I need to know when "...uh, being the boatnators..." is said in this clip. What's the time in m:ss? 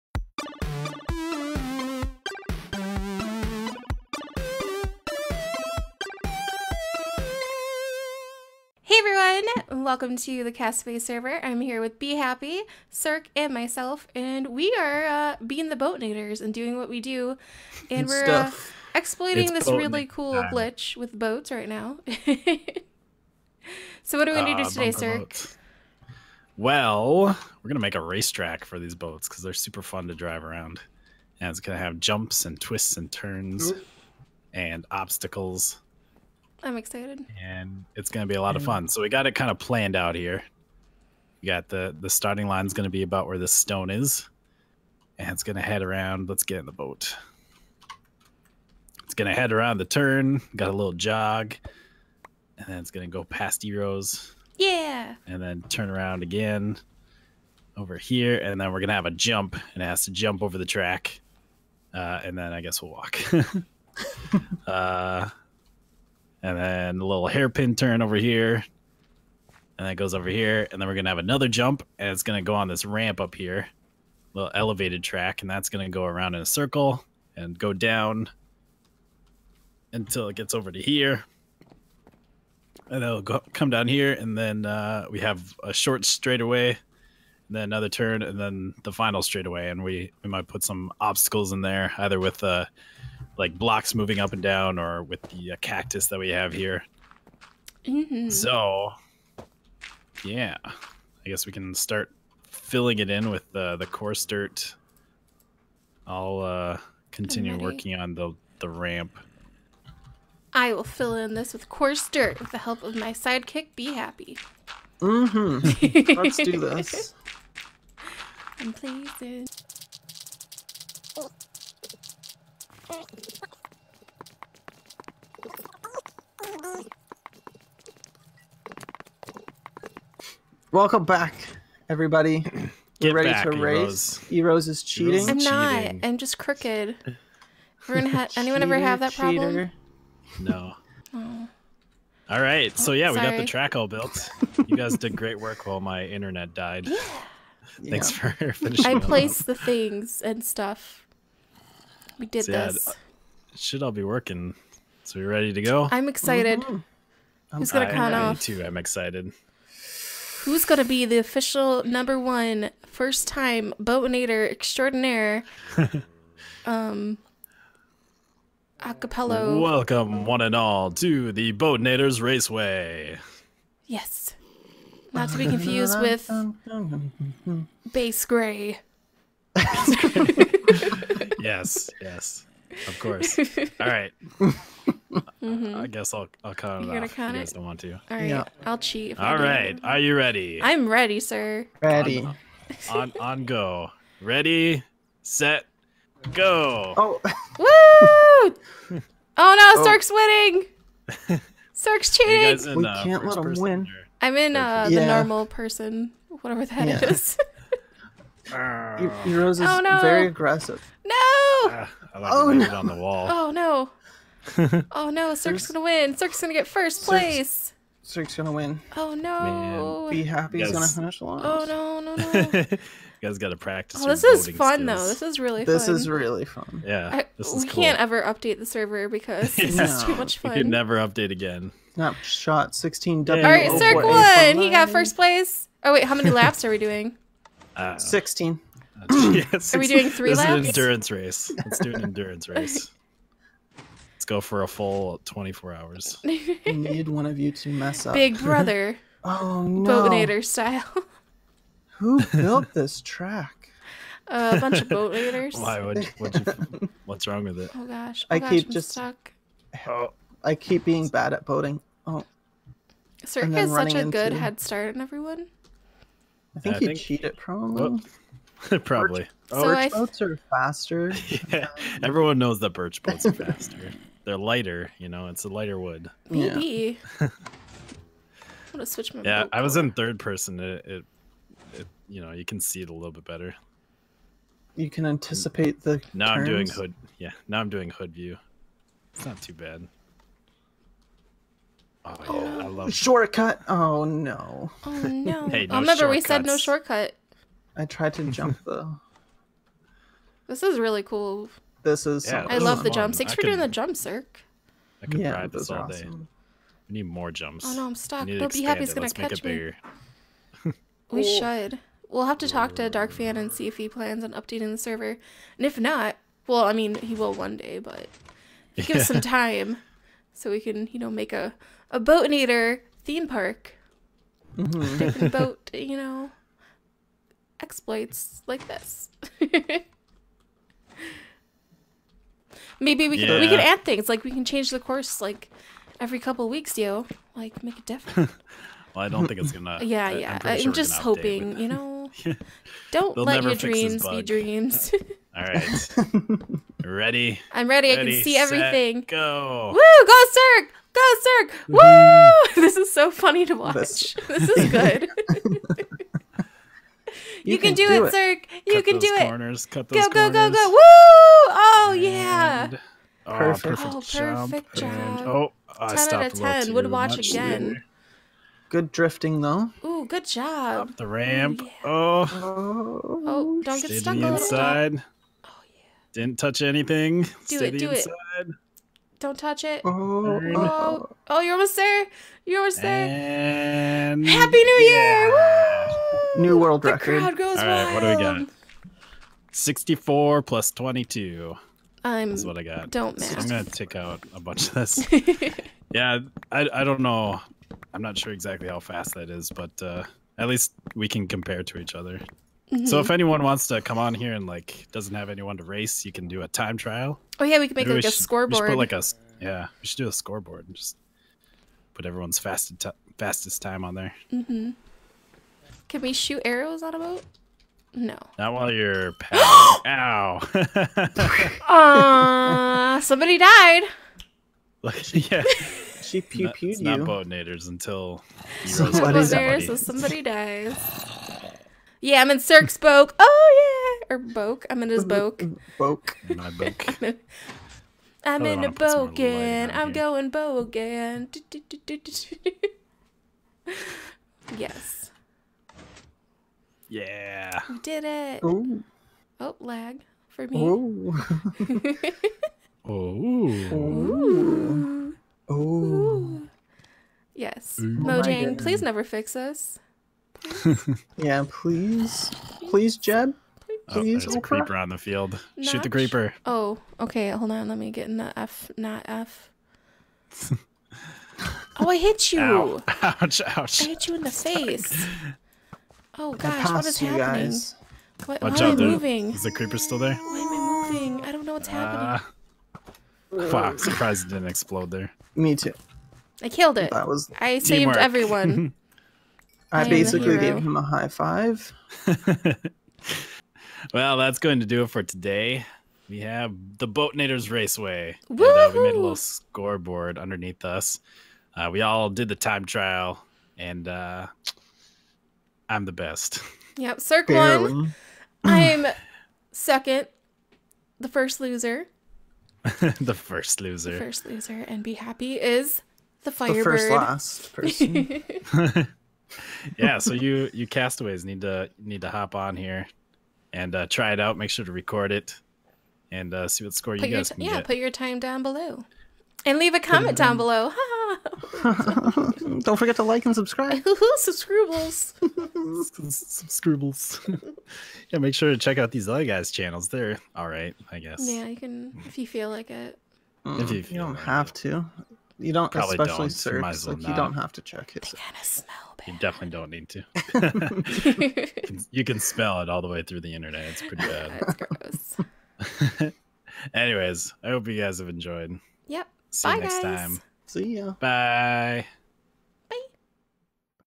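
0:15.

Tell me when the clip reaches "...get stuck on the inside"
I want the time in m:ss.
6:13.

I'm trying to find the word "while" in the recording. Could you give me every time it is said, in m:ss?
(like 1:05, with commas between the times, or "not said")
2:25, 6:58.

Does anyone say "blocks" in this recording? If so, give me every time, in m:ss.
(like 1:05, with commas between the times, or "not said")
1:33.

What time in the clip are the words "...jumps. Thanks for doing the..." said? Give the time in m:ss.
5:02.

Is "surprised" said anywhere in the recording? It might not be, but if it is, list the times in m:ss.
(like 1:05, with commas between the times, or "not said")
8:03.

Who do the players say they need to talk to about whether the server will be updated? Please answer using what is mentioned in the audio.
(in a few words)
Dark Fan.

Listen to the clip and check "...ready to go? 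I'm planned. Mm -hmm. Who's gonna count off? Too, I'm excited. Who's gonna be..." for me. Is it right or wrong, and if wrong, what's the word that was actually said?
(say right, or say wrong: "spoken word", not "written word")
wrong: "excited", not "planned".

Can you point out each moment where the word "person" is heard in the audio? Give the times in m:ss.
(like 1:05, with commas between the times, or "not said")
3:25, 4:40, 8:37.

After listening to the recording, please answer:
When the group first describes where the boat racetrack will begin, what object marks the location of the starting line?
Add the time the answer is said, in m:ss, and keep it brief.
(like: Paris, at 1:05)
the stone, at 0:43.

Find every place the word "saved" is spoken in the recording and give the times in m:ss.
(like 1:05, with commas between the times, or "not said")
8:07.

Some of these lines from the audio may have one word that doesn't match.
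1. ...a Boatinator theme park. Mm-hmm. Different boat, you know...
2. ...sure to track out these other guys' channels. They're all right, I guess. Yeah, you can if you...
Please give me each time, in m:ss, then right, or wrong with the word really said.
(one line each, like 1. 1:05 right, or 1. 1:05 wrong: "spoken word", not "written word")
1. 5:21 right
2. 8:58 wrong: "check", not "track".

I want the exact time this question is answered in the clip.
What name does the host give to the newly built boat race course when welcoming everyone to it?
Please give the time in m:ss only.
2:51.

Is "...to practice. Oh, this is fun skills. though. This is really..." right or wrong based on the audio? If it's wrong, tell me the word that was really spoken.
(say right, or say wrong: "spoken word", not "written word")
right.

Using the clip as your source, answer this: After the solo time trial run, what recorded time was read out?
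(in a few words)
64 plus 22.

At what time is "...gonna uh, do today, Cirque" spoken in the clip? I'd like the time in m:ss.
0:24.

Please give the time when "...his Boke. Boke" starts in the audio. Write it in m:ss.
7:14.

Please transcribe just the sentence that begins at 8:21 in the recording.
Uh, we all did the time trial, and uh, I'm the best.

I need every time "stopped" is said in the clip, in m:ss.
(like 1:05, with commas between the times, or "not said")
6:05.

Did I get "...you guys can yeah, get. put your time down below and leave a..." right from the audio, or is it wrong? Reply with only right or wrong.
right.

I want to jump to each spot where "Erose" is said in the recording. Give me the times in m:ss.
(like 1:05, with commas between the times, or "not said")
0:53, 3:28.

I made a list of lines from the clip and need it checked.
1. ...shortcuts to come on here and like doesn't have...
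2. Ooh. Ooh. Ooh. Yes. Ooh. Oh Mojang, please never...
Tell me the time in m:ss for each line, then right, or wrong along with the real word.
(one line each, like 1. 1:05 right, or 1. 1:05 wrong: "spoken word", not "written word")
1. 6:43 wrong: "wants", not "shortcuts"
2. 7:32 right.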